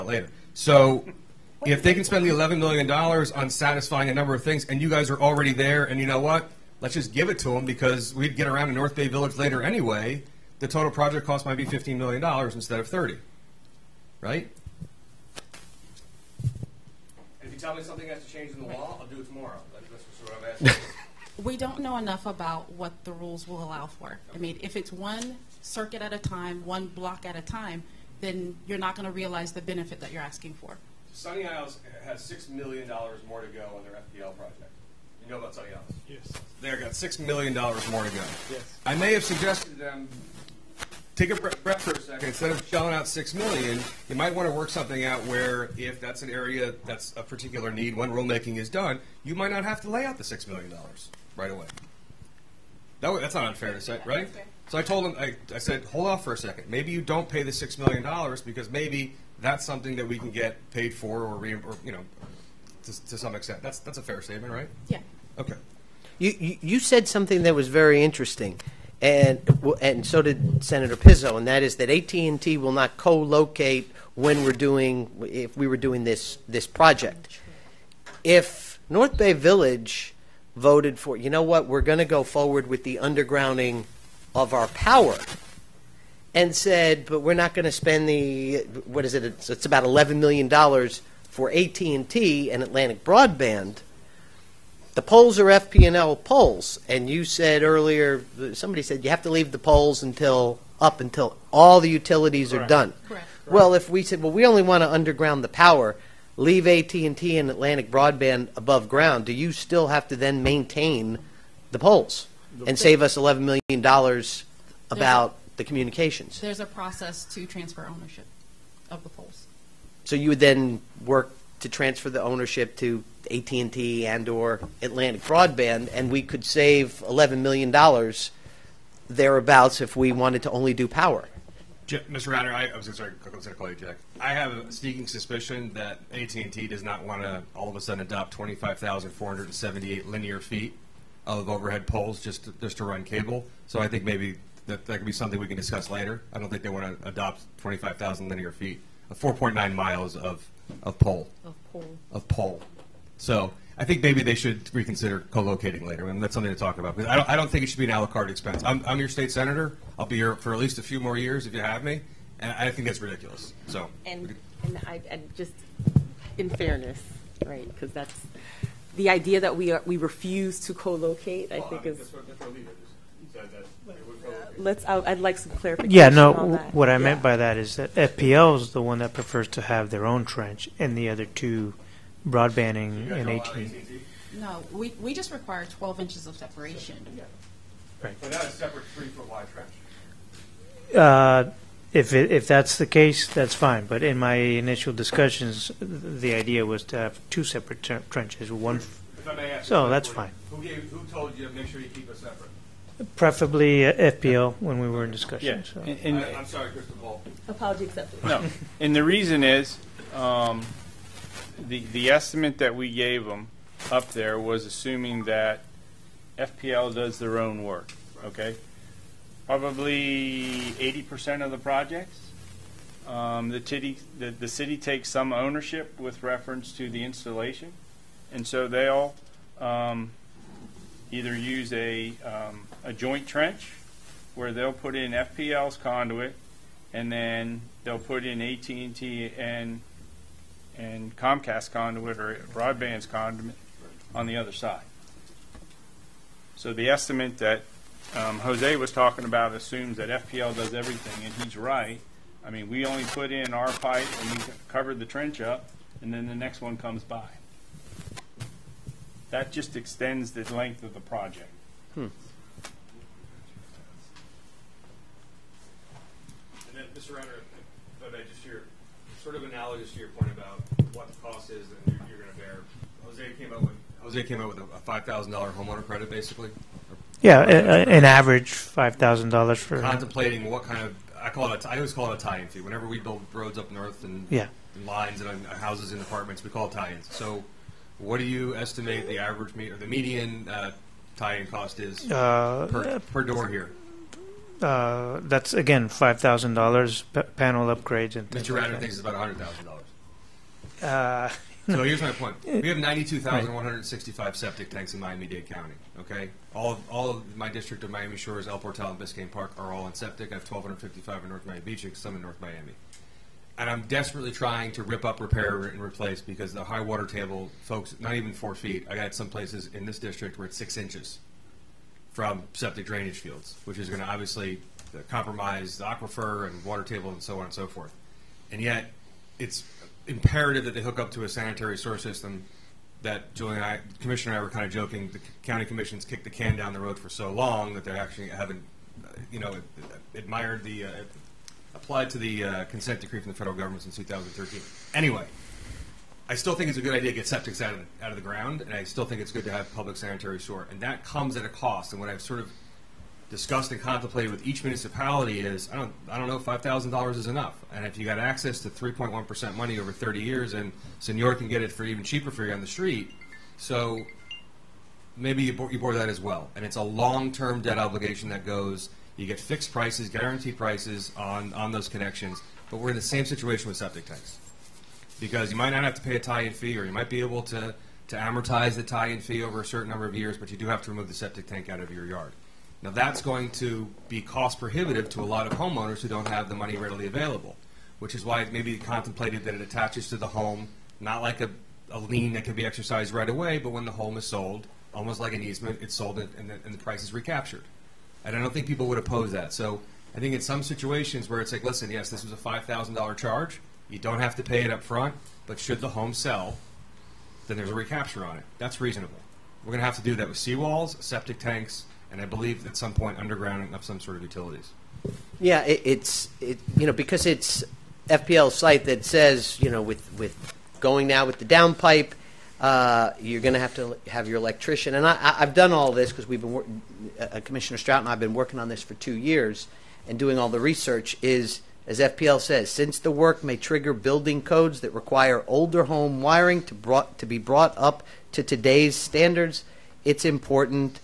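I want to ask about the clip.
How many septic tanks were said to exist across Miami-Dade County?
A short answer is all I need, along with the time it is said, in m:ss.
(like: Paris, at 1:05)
92,165, at 5:02.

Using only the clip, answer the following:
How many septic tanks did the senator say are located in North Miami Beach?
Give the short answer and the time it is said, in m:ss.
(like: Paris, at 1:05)
1,255, at 5:10.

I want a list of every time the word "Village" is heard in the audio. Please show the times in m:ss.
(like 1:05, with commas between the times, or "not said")
0:09, 1:19.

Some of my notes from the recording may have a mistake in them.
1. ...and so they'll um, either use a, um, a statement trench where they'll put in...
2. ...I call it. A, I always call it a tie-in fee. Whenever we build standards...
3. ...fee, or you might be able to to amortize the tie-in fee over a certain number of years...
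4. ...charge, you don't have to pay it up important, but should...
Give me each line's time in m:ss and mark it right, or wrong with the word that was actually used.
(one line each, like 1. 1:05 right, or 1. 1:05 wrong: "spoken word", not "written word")
1. 3:48 wrong: "joint", not "statement"
2. 4:41 wrong: "roads", not "standards"
3. 6:16 right
4. 6:43 wrong: "front", not "important".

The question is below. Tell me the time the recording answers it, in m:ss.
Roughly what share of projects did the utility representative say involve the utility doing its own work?
3:40.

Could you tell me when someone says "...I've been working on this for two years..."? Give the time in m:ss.
7:08.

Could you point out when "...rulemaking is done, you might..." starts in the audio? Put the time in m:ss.
0:48.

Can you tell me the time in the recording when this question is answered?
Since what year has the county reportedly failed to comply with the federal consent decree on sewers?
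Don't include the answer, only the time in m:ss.
5:43.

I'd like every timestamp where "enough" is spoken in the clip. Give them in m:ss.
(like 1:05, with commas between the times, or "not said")
0:21, 5:57.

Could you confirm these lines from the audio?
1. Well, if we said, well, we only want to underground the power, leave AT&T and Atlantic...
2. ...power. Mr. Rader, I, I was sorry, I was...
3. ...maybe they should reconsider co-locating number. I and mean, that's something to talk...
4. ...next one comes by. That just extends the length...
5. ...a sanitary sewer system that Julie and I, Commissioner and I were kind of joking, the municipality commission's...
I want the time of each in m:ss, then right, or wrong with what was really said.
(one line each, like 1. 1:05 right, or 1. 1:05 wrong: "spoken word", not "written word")
1. 1:43 right
2. 2:10 right
3. 2:34 wrong: "later", not "number"
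4. 4:16 right
5. 5:31 wrong: "county", not "municipality".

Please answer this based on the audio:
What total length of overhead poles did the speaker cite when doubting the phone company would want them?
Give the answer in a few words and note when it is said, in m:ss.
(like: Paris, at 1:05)
25,478 linear feet, at 2:18.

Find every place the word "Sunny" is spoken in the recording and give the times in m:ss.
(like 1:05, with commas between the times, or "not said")
0:31, 0:35.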